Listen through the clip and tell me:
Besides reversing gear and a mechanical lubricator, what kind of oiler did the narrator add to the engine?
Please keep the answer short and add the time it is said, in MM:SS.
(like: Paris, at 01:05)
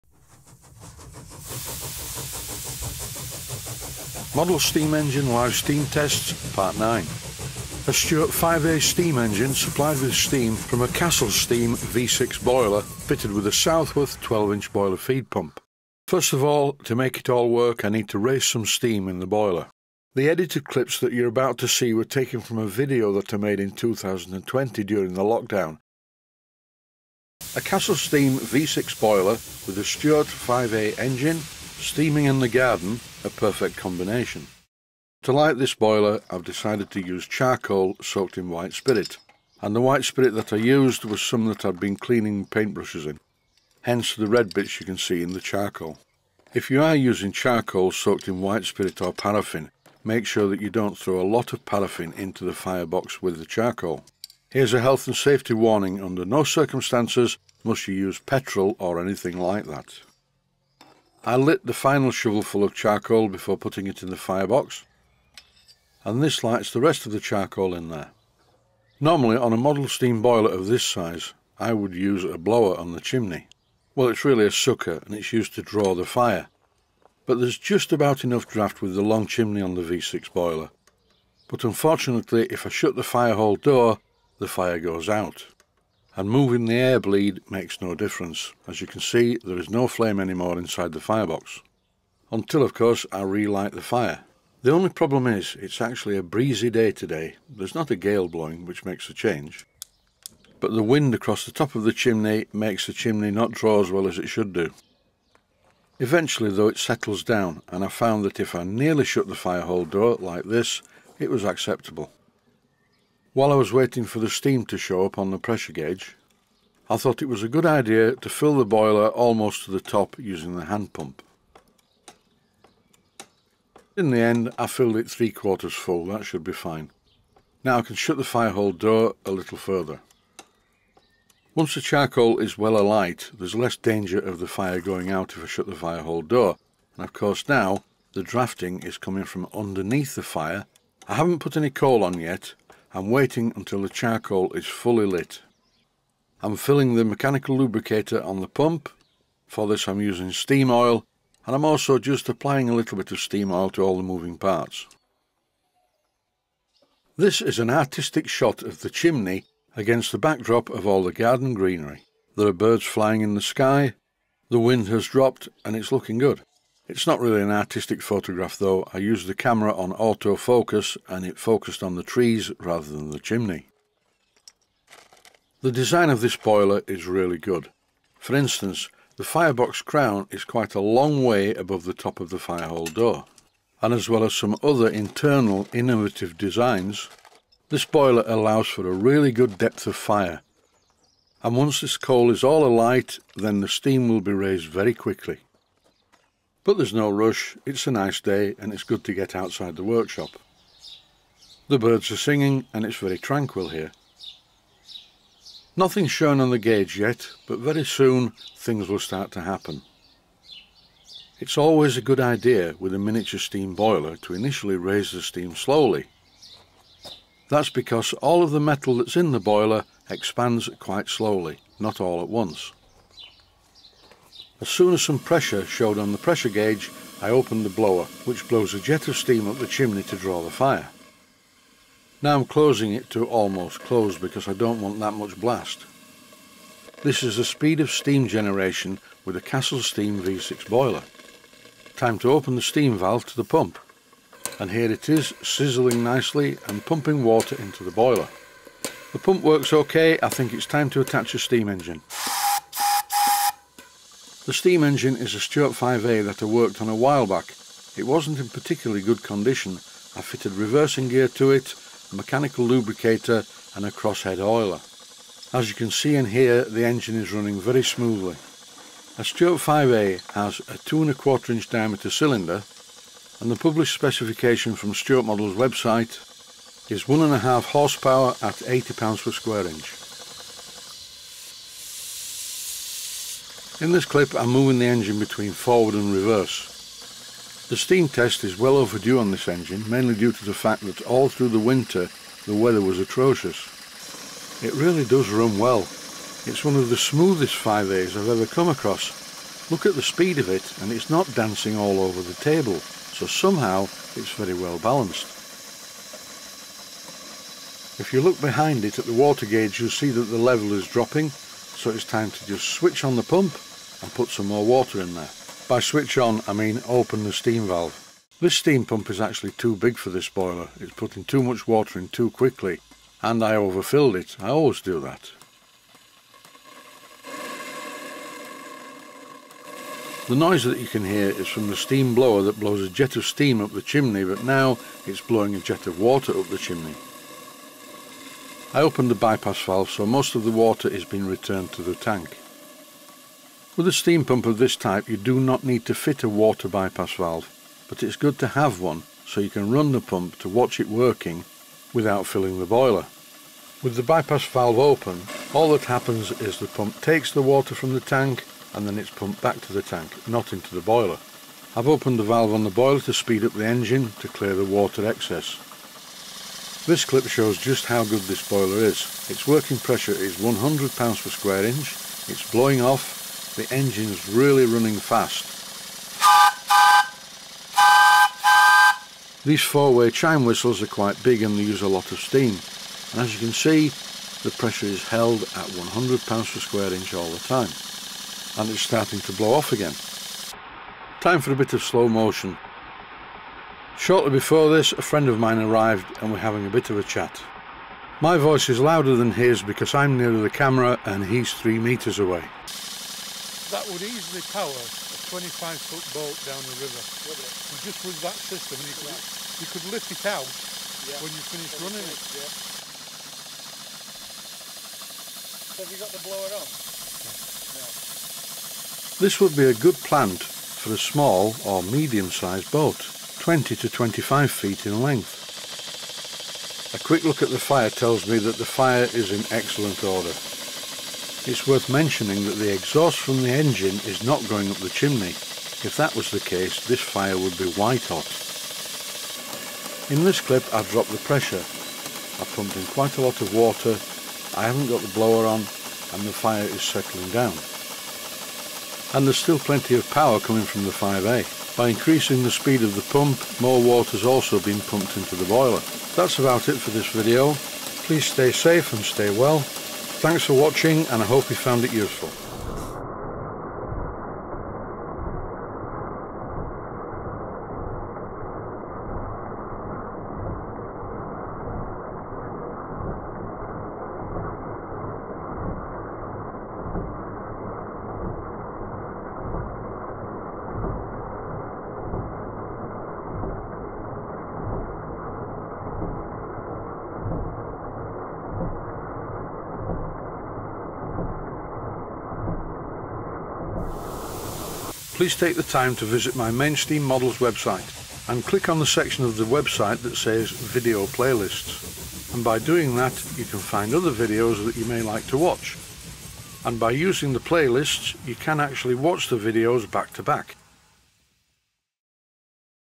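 crosshead oiler, at 04:23.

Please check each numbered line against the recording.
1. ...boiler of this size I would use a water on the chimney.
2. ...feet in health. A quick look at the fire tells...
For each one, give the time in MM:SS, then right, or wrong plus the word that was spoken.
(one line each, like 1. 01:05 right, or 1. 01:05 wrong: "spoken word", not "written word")
1. 01:10 wrong: "blower", not "water"
2. 07:04 wrong: "length", not "health".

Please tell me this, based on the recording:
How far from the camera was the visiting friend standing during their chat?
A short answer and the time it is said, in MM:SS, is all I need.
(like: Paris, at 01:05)
3 meters, at 06:41.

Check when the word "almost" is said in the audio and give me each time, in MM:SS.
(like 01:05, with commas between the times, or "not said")
01:59, 03:53.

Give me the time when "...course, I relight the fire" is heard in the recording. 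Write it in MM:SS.
01:32.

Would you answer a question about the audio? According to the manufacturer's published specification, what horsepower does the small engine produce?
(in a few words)
1.5 horsepower.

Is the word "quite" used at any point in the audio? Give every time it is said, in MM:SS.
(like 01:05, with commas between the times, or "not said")
03:00, 03:40, 06:20, 07:22.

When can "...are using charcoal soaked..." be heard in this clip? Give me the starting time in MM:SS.
00:46.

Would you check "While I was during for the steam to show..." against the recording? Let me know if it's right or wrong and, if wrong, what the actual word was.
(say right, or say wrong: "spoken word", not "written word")
wrong: "waiting", not "during".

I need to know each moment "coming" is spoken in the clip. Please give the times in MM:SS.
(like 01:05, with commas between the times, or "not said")
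02:18, 07:30.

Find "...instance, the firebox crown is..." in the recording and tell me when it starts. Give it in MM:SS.
02:58.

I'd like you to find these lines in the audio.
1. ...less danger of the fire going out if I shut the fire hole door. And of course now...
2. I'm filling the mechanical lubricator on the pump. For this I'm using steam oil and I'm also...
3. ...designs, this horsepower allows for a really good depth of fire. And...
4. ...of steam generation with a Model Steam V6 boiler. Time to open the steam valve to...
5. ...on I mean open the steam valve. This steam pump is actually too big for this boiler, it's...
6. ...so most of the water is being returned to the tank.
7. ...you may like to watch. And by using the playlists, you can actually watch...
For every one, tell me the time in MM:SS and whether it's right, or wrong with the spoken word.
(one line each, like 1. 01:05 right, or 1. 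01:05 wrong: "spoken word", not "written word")
1. 02:13 right
2. 02:26 right
3. 03:06 wrong: "boiler", not "horsepower"
4. 03:57 wrong: "Castle", not "Model"
5. 05:16 right
6. 05:39 right
7. 08:24 right.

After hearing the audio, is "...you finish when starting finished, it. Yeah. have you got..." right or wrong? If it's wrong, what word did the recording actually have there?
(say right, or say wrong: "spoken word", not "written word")
wrong: "running", not "starting".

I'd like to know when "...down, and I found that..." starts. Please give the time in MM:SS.
01:47.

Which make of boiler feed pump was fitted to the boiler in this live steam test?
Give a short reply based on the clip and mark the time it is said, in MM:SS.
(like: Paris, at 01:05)
Southworth, at 00:13.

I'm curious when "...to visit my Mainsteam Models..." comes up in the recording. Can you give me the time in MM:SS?
08:15.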